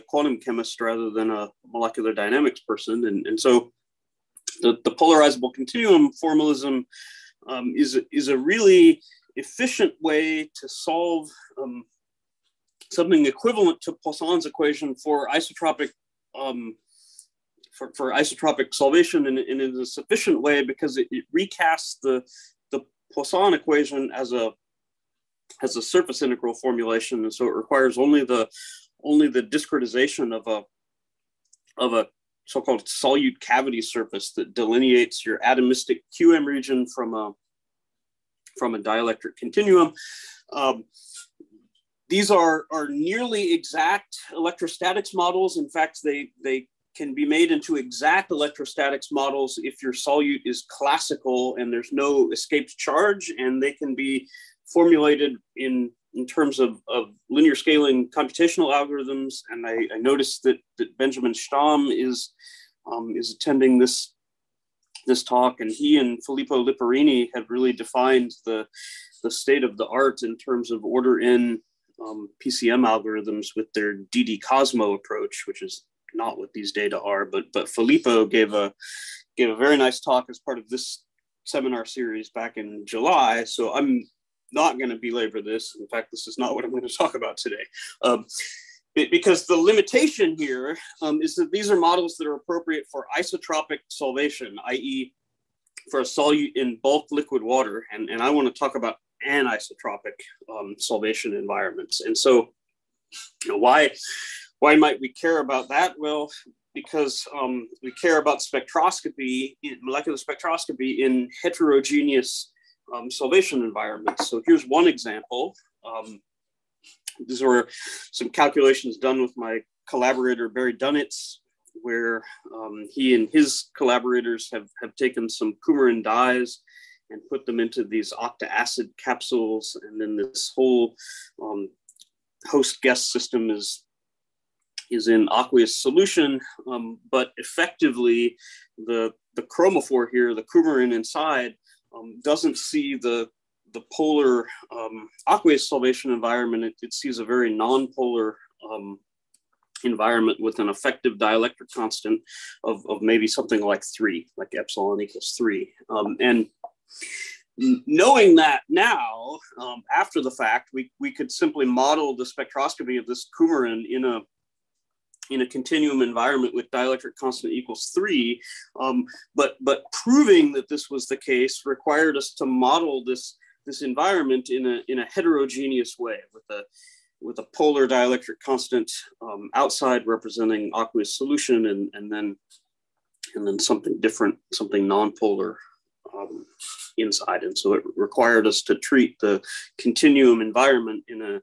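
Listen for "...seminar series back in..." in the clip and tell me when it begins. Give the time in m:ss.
1:21.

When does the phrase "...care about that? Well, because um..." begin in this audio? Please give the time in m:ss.
1:45.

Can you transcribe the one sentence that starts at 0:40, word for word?
Um, these are, are nearly exact electrostatics models.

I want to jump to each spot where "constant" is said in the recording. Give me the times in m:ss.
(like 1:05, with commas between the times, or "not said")
2:31, 2:47, 2:58.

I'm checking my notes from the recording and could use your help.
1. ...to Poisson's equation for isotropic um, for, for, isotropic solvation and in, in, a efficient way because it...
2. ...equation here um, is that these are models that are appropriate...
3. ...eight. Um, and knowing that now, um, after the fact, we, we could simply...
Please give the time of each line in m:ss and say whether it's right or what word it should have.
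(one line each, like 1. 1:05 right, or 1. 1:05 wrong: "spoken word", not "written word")
1. 0:13 wrong: "sufficient", not "efficient"
2. 1:29 wrong: "limitation", not "equation"
3. 2:35 wrong: "three", not "eight".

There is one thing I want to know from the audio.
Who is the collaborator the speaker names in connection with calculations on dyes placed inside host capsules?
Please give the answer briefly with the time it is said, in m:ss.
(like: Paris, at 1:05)
Barry Dunietz, at 2:00.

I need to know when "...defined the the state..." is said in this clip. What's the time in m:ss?
1:07.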